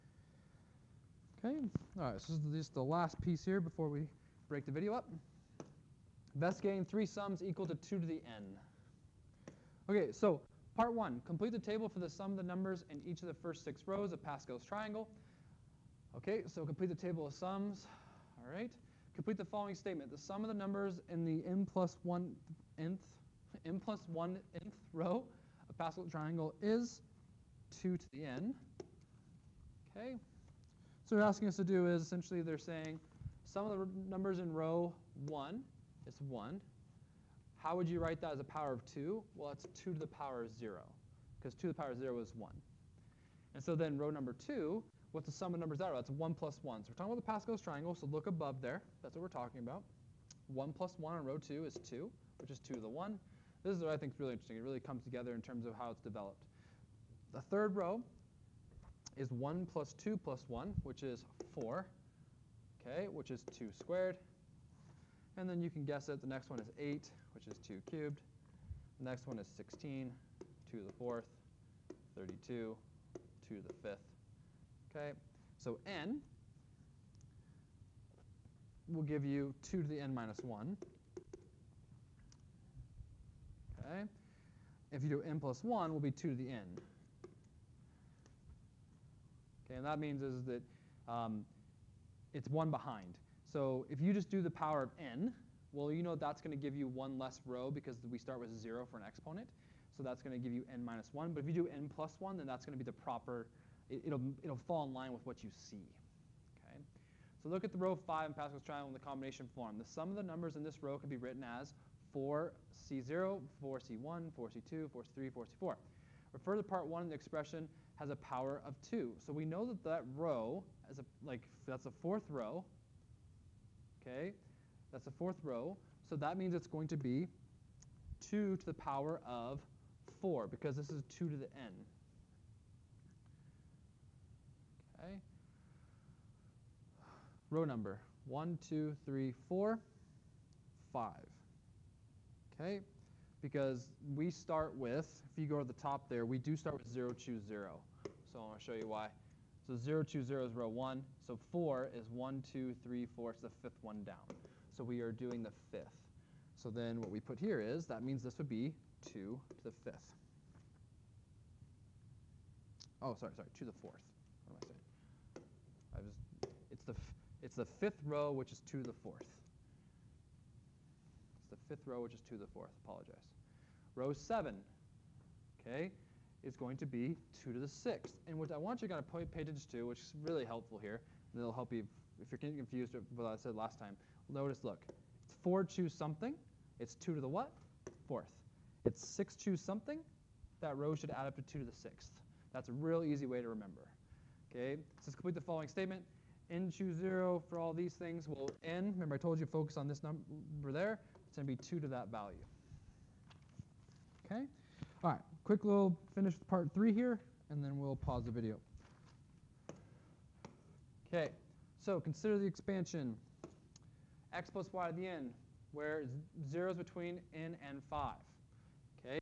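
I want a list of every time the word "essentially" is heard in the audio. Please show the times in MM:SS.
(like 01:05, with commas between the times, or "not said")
00:32.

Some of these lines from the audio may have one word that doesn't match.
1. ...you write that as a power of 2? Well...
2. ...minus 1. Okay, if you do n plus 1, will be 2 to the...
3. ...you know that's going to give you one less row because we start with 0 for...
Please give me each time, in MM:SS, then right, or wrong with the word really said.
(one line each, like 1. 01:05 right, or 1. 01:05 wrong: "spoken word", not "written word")
1. 00:37 right
2. 01:20 right
3. 01:35 right.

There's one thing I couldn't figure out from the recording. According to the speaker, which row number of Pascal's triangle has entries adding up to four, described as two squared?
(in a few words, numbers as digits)
third row.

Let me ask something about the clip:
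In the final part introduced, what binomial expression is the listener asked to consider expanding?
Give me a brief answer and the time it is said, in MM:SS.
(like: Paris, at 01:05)
x plus y to the n, at 03:34.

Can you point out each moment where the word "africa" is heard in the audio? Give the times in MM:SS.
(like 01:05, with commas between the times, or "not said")
not said.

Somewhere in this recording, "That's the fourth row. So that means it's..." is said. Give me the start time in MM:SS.
02:04.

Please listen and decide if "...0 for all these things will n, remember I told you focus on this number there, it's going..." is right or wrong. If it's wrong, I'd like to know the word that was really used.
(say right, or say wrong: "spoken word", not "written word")
right.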